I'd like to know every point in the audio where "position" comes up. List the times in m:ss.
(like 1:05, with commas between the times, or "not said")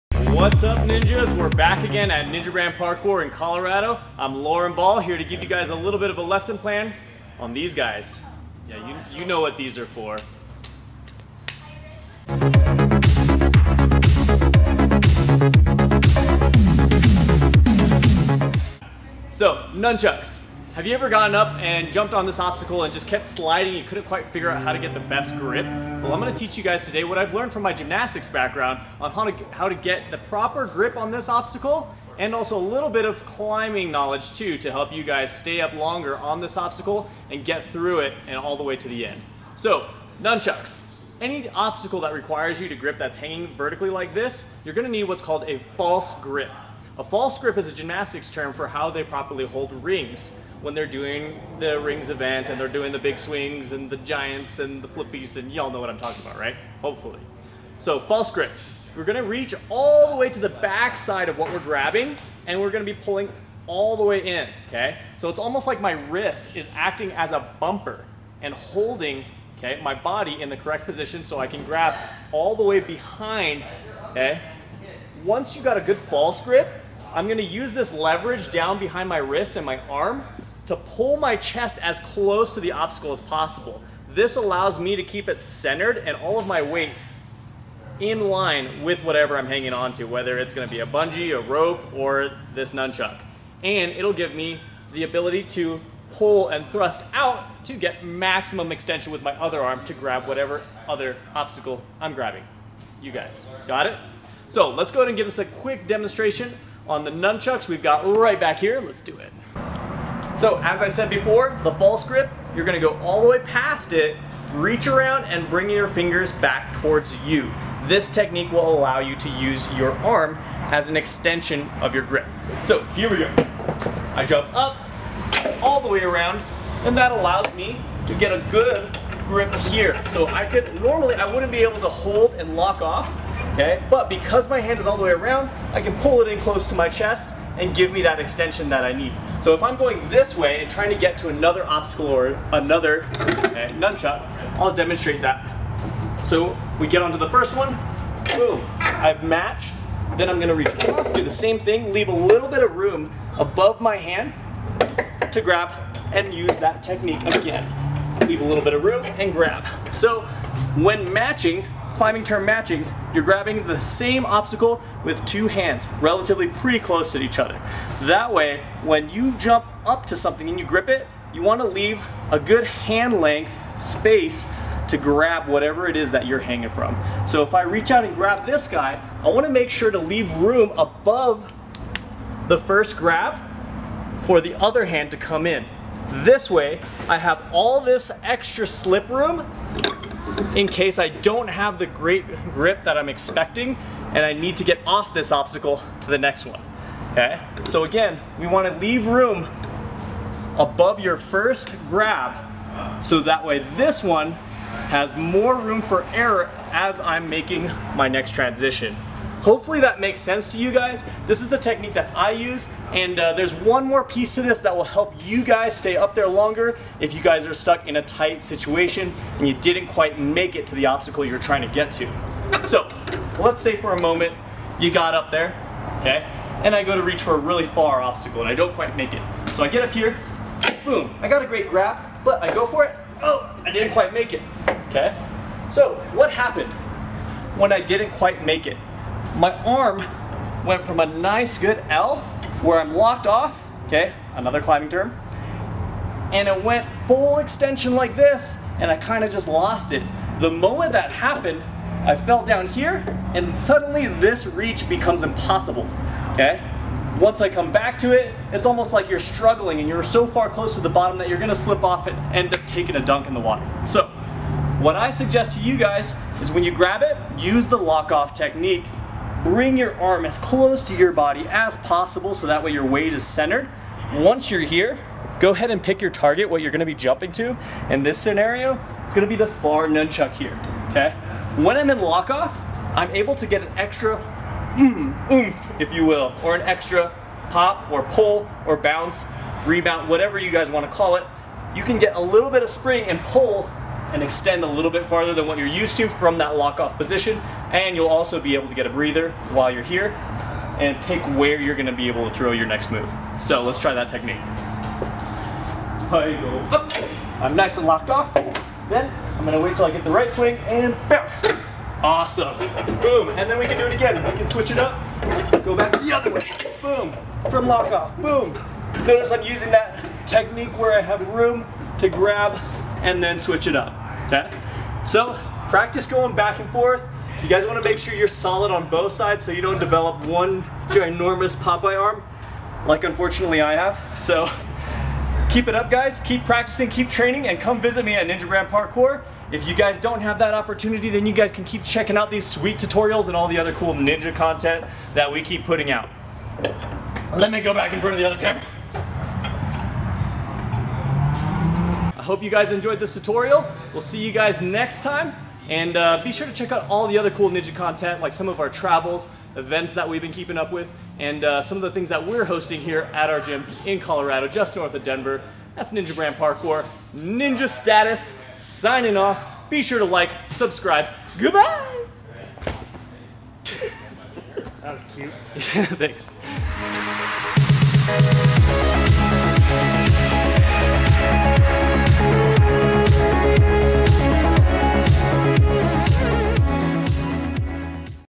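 1:10, 4:56.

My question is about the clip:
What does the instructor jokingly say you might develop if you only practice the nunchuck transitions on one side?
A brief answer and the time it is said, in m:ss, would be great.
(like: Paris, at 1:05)
Popeye arm, at 5:31.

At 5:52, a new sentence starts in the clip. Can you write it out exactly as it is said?
I hope you guys enjoyed this tutorial.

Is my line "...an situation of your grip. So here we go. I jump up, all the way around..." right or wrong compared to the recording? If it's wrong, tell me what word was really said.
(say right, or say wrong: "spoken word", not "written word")
wrong: "extension", not "situation".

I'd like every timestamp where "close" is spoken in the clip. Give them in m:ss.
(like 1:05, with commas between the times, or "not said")
1:21, 2:16, 2:46, 4:20, 4:30.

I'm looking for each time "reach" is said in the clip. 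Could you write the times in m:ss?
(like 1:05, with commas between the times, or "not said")
0:59, 1:54, 2:30, 2:57, 3:47, 4:14.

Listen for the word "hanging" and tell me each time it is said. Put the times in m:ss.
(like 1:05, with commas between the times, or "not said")
0:43, 1:29, 2:56.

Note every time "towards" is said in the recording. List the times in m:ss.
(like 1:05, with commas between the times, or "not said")
1:56.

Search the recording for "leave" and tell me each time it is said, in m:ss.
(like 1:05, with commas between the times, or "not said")
2:31, 2:38, 2:51, 2:59, 3:18.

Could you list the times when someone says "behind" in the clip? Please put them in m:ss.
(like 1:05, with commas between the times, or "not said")
1:12, 1:18.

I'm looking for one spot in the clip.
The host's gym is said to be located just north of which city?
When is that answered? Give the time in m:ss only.
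6:05.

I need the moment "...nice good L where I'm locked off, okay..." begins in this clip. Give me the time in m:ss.
4:01.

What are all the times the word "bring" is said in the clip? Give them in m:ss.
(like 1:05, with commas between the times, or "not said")
1:55, 4:29.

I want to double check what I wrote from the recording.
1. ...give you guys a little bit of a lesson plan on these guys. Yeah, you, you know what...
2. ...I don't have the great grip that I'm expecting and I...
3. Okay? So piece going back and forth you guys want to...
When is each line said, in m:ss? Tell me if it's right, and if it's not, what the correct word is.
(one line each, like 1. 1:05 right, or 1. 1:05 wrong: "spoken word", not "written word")
1. 0:05 right
2. 3:10 right
3. 5:24 wrong: "practice", not "piece".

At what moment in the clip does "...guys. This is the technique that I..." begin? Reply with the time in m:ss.
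3:30.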